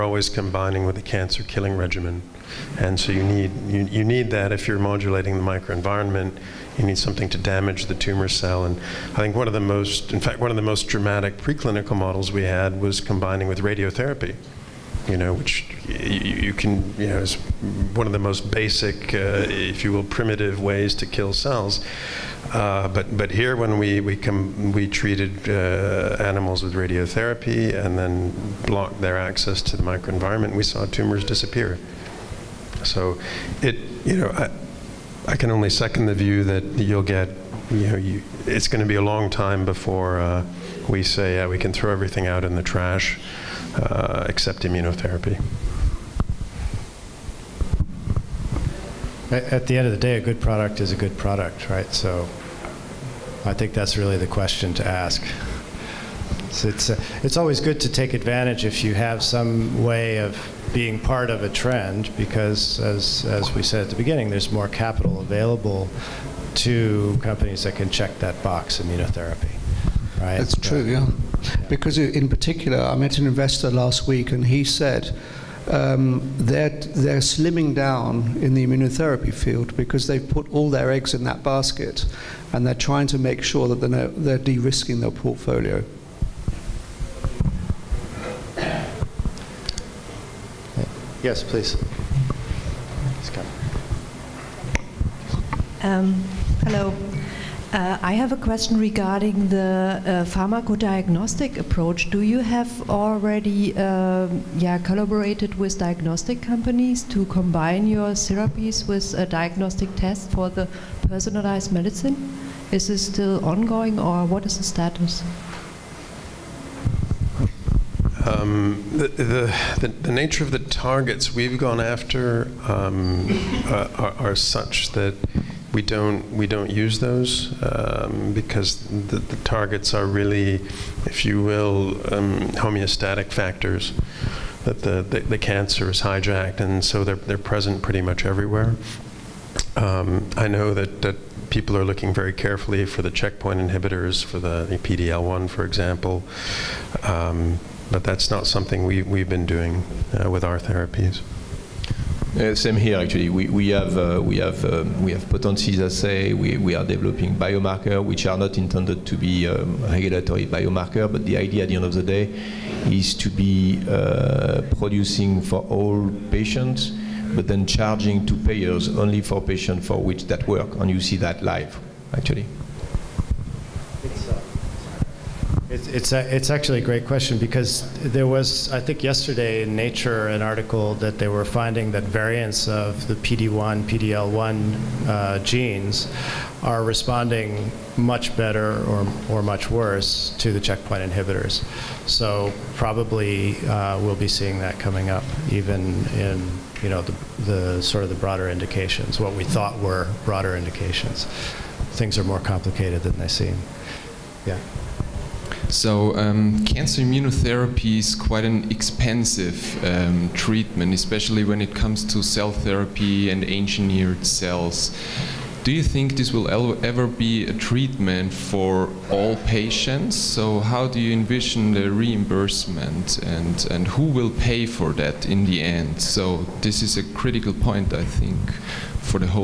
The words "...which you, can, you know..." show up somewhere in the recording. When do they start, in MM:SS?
00:15.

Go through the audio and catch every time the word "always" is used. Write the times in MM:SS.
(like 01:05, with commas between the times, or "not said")
00:00, 00:57.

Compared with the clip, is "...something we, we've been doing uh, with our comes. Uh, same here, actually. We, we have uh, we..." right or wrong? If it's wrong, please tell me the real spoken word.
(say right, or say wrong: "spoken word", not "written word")
wrong: "therapies", not "comes".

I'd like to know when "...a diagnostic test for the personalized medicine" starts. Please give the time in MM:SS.
01:49.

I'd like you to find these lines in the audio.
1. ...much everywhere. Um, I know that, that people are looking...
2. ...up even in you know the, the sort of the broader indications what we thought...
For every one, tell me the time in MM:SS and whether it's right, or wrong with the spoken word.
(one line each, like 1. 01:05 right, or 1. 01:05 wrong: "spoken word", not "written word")
1. 02:18 right
2. 03:15 right.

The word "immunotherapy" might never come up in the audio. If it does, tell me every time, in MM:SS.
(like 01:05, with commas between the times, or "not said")
00:44, 01:08, 01:18, 03:27.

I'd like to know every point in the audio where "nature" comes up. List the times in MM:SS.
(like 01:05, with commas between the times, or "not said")
02:00, 02:59.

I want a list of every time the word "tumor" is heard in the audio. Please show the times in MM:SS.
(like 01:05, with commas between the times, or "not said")
00:07, 00:30.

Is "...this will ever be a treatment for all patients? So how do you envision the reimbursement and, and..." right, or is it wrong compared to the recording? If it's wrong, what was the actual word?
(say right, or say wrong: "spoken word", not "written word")
right.